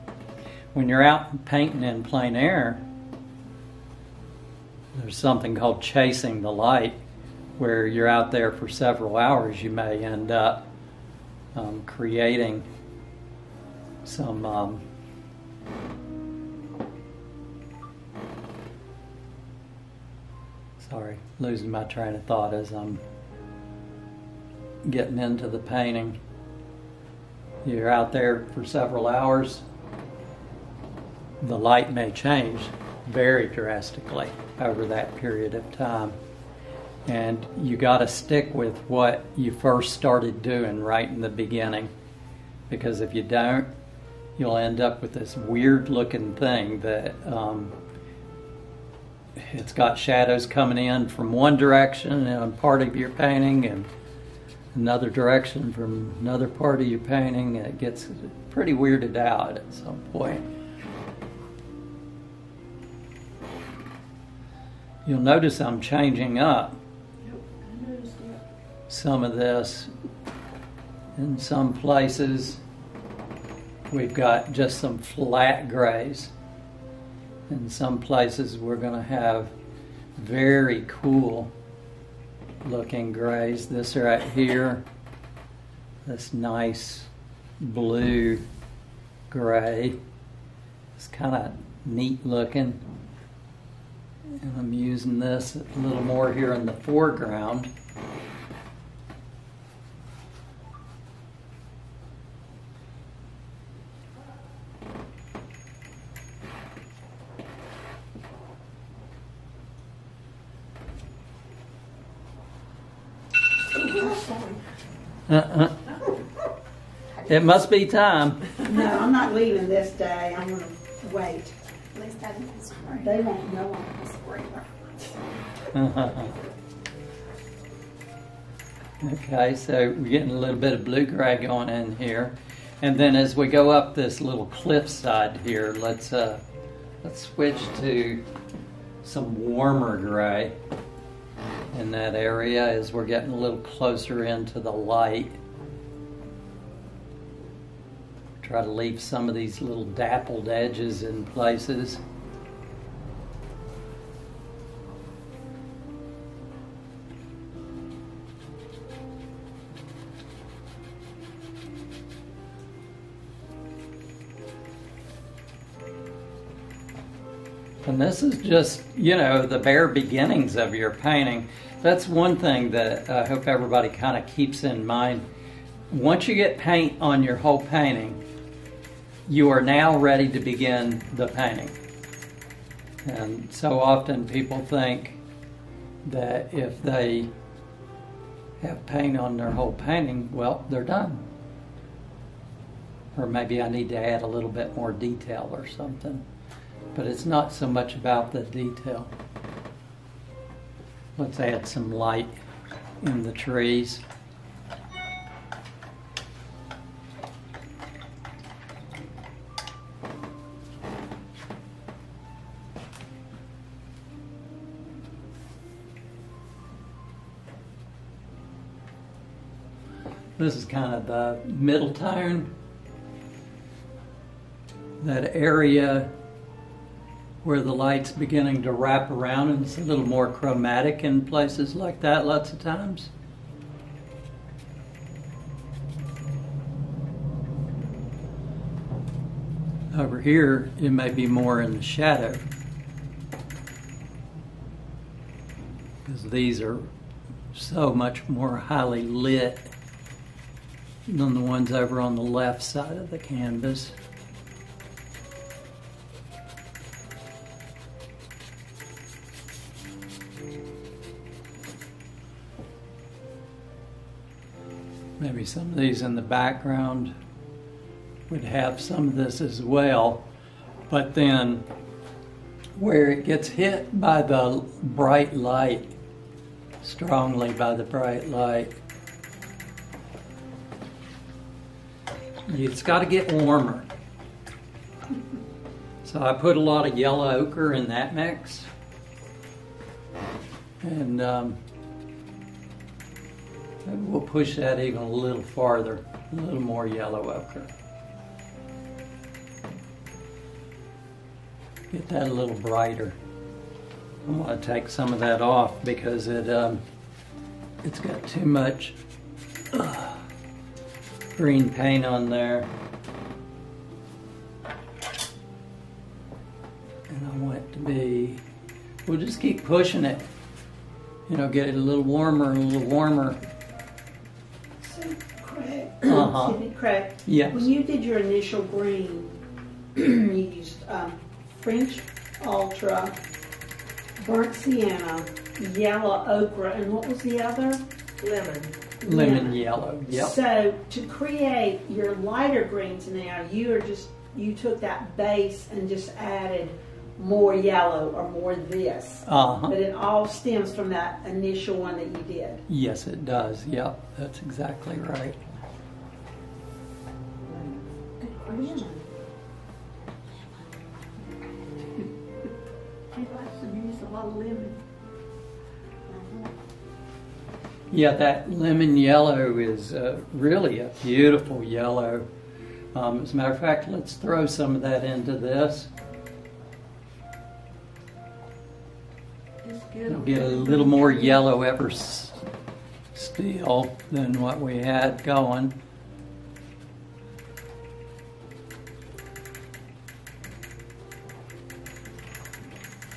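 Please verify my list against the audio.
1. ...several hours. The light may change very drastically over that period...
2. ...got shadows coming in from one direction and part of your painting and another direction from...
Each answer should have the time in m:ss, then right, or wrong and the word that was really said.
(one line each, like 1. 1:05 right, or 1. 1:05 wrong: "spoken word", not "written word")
1. 0:28 right
2. 0:49 right.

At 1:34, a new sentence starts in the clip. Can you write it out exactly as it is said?
And I'm using this a little more here in the foreground.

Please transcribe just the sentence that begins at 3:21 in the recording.
Let's add some light in the trees.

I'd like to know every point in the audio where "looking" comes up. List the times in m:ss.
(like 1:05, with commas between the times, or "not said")
0:45, 1:22, 1:32.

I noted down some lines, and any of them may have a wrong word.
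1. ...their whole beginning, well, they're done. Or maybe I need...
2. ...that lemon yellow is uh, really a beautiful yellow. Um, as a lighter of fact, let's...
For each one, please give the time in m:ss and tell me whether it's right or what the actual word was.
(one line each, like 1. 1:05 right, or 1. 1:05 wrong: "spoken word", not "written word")
1. 3:09 wrong: "painting", not "beginning"
2. 6:08 wrong: "matter", not "lighter".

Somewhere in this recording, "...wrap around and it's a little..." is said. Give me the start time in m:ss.
3:48.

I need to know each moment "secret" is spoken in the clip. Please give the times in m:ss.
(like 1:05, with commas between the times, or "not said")
not said.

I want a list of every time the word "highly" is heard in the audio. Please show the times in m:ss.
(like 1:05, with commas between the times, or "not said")
4:08.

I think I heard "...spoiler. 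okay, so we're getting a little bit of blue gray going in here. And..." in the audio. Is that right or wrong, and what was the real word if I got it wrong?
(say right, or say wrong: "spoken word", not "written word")
right.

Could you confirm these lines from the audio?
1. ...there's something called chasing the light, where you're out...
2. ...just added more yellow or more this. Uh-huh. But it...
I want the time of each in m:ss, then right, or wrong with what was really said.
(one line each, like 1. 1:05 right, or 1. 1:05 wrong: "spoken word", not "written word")
1. 0:04 right
2. 5:45 right.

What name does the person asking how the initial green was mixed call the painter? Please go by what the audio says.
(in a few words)
Craig.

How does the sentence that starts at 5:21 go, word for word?
You know, get it a little warmer, a little warmer.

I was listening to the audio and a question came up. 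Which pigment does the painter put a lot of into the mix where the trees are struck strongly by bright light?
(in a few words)
yellow ochre.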